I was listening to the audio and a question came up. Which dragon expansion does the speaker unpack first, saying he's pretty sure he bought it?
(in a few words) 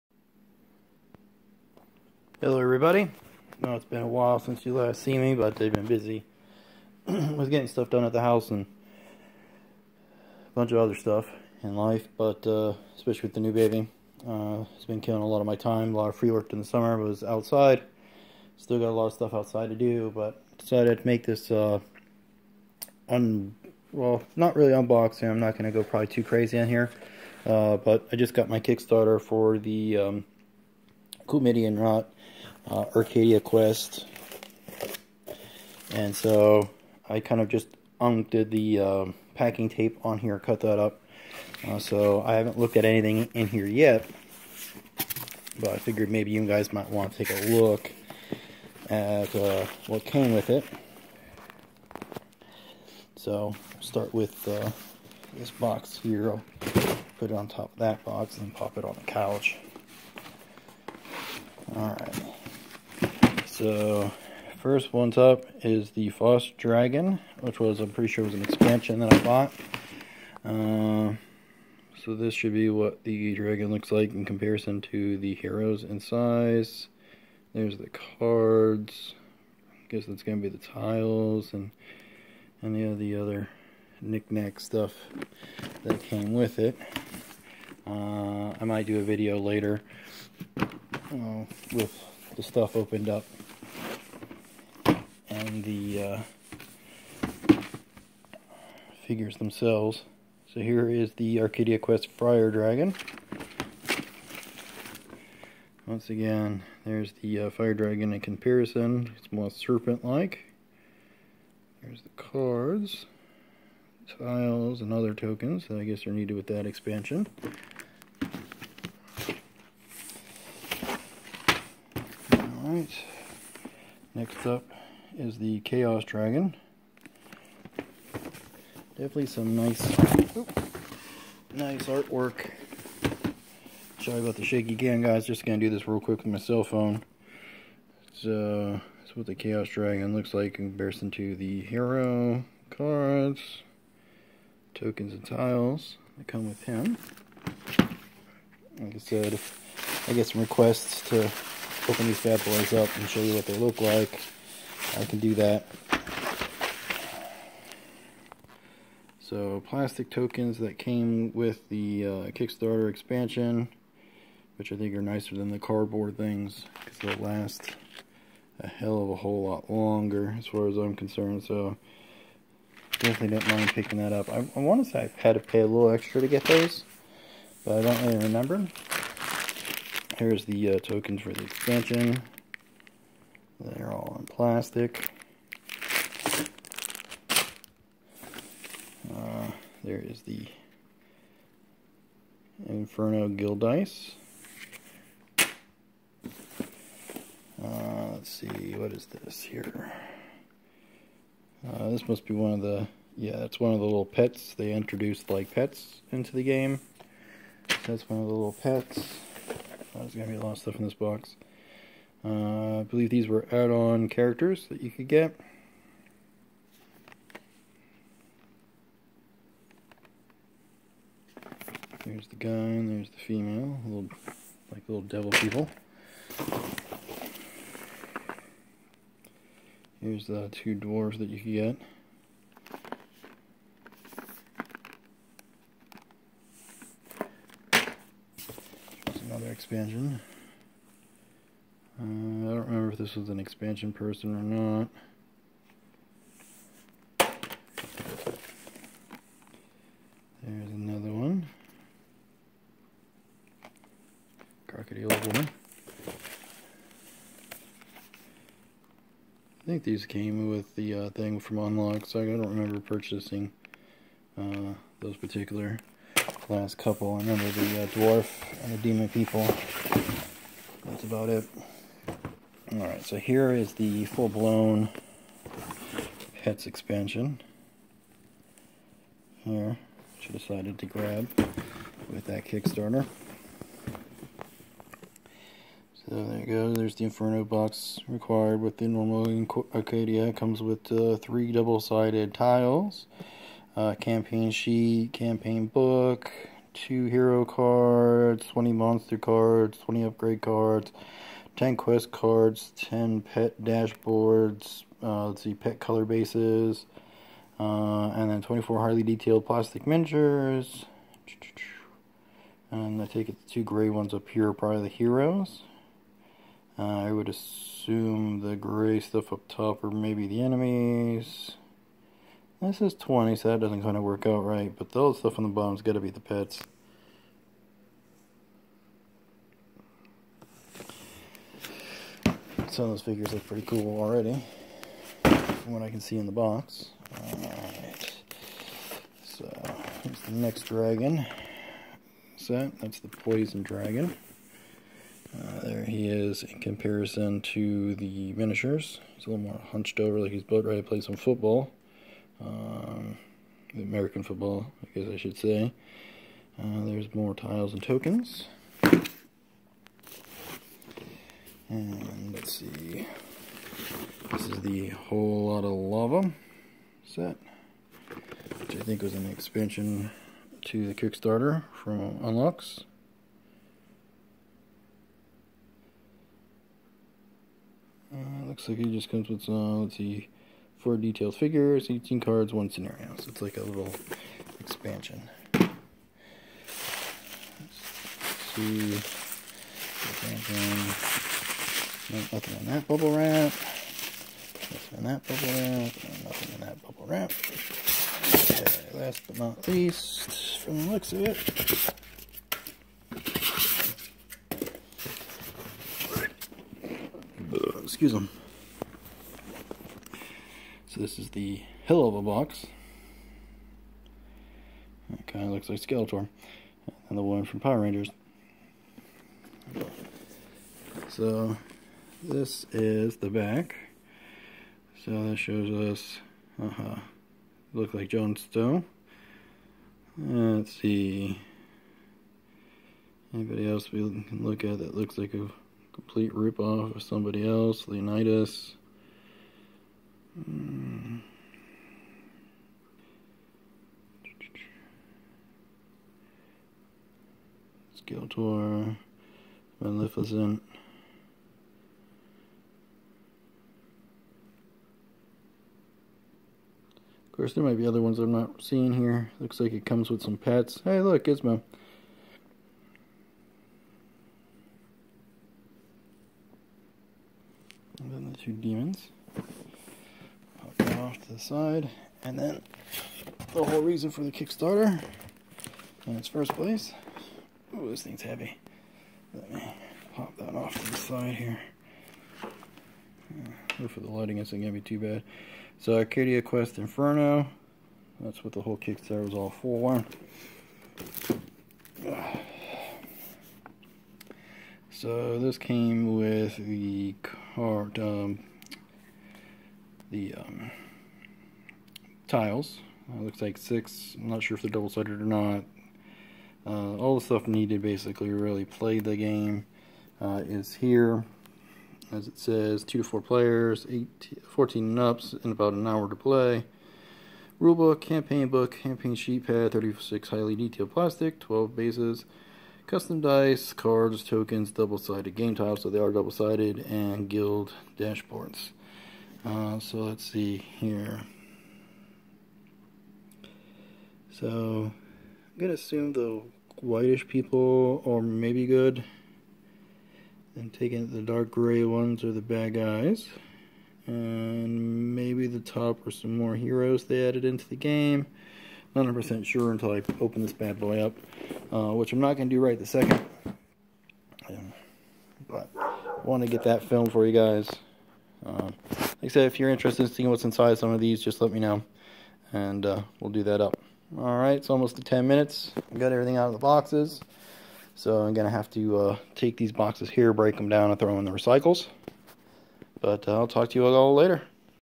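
Frost Dragon.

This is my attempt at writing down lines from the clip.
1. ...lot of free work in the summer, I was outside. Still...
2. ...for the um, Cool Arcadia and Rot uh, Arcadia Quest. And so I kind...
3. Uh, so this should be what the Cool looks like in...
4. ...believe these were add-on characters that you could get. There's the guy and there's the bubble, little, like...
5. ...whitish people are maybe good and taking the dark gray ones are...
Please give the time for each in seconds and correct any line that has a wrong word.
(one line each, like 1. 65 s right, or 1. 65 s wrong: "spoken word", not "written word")
1. 15 s right
2. 29 s wrong: "MIDI", not "Arcadia"
3. 70 s wrong: "Dragon", not "Cool"
4. 212 s wrong: "female", not "bubble"
5. 536 s right.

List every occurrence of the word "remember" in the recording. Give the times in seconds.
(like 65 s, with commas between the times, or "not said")
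178 s, 262 s, 267 s.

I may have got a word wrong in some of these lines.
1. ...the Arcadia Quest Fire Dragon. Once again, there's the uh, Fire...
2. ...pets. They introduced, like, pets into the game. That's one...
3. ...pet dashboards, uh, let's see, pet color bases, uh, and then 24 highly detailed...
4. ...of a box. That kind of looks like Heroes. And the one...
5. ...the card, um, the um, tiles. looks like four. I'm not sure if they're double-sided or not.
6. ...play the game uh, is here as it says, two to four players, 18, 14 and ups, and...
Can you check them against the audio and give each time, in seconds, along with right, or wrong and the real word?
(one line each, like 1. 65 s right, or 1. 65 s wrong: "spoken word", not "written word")
1. 101 s right
2. 204 s right
3. 303 s right
4. 412 s wrong: "Skeletor", not "Heroes"
5. 496 s wrong: "six", not "four"
6. 508 s right.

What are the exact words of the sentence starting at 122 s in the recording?
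Alright, next up is the Chaos Dragon.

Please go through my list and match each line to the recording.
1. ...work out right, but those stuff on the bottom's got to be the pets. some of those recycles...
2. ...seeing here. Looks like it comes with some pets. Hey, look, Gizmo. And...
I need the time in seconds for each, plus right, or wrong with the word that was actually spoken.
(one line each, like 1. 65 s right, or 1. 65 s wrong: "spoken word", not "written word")
1. 324 s wrong: "figures", not "recycles"
2. 458 s right.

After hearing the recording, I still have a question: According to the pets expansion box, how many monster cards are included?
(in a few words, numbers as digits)
20.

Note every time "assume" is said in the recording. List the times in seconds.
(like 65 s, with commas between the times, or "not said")
317 s, 535 s.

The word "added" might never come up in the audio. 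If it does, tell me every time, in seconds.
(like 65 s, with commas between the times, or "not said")
547 s.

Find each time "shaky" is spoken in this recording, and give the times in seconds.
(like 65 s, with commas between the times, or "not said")
134 s.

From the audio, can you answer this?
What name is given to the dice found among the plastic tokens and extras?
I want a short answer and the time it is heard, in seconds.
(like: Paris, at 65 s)
Inferno Guild Dice, at 192 s.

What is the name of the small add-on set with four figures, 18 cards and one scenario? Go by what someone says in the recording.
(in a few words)
Whole Lotta Lava.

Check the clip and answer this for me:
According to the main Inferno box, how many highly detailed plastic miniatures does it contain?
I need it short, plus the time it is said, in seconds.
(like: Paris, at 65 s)
36, at 519 s.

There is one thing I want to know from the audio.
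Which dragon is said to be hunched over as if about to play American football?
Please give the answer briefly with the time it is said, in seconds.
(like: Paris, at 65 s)
Poison Dragon, at 343 s.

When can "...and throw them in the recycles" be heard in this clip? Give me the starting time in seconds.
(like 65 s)
570 s.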